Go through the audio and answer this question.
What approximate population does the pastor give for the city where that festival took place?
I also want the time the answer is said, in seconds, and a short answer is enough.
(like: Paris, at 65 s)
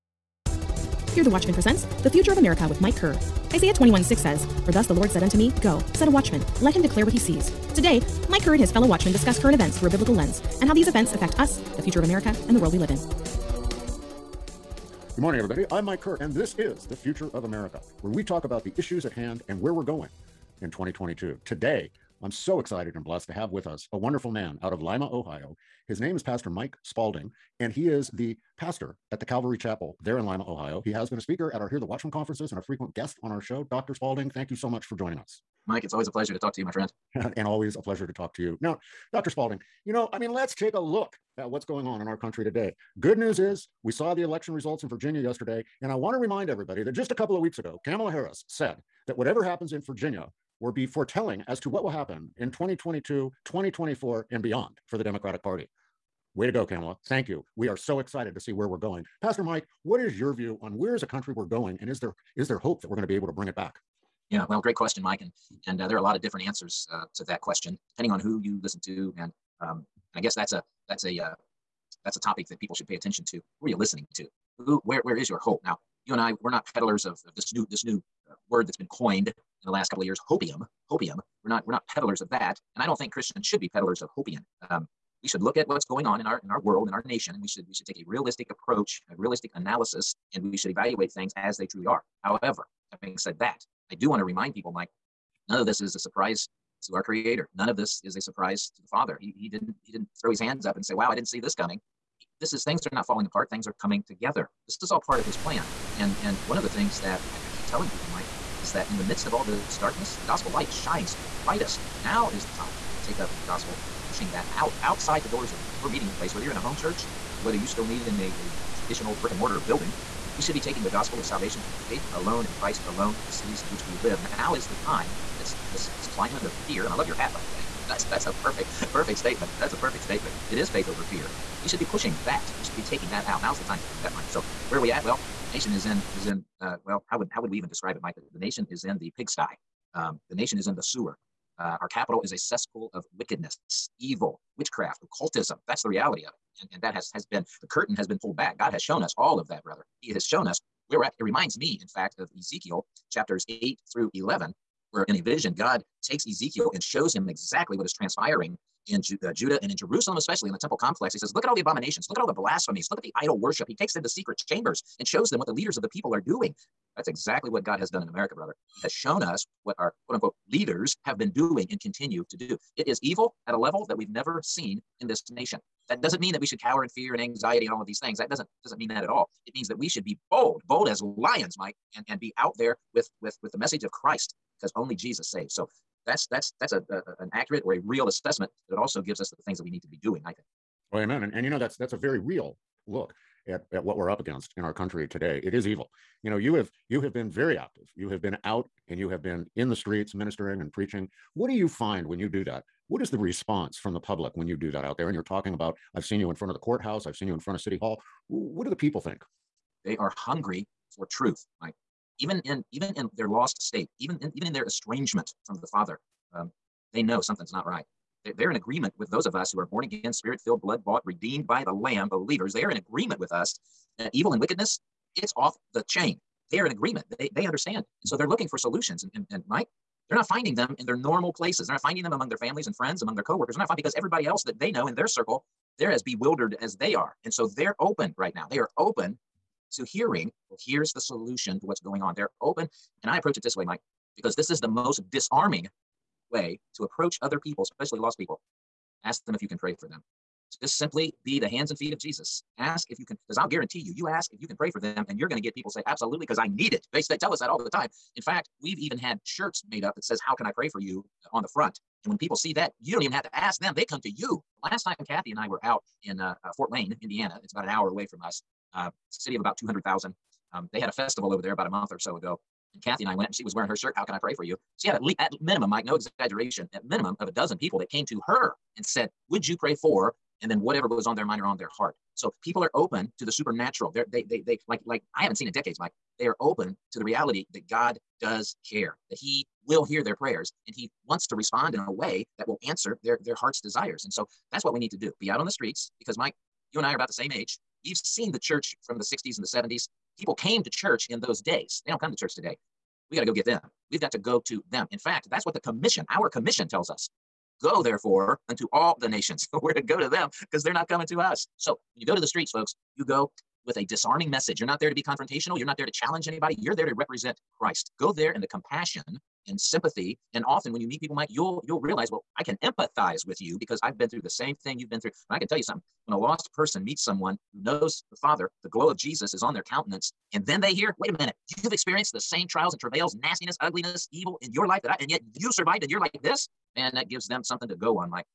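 200,000, at 269 s.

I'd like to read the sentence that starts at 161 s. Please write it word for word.
He says, Look at all the abominations, look at all the blasphemies, look at the idol worship.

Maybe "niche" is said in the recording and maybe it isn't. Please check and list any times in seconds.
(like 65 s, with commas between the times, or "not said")
not said.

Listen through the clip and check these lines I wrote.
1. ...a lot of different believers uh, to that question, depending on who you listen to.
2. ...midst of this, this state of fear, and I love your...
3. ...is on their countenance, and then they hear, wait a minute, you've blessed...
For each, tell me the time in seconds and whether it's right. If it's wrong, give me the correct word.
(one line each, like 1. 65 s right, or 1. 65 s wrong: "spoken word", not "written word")
1. 65 s wrong: "answers", not "believers"
2. 125 s wrong: "climate", not "state"
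3. 329 s wrong: "experienced", not "blessed".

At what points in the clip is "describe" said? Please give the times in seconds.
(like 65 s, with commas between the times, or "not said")
137 s.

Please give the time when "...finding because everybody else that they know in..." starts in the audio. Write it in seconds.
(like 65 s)
233 s.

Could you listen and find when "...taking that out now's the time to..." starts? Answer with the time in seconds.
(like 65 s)
132 s.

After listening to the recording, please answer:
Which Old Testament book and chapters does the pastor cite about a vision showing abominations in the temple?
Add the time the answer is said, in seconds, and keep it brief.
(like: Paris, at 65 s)
Ezekiel 8 through 11, at 152 s.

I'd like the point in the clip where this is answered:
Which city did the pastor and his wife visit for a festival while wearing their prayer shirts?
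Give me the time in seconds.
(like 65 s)
266 s.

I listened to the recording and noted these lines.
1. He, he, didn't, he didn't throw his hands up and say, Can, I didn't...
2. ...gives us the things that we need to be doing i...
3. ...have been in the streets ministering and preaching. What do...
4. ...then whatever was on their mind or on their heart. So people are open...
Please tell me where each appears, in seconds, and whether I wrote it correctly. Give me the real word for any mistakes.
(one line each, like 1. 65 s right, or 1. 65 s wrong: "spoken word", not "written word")
1. 99 s wrong: "Wow", not "Can"
2. 189 s right
3. 199 s right
4. 280 s right.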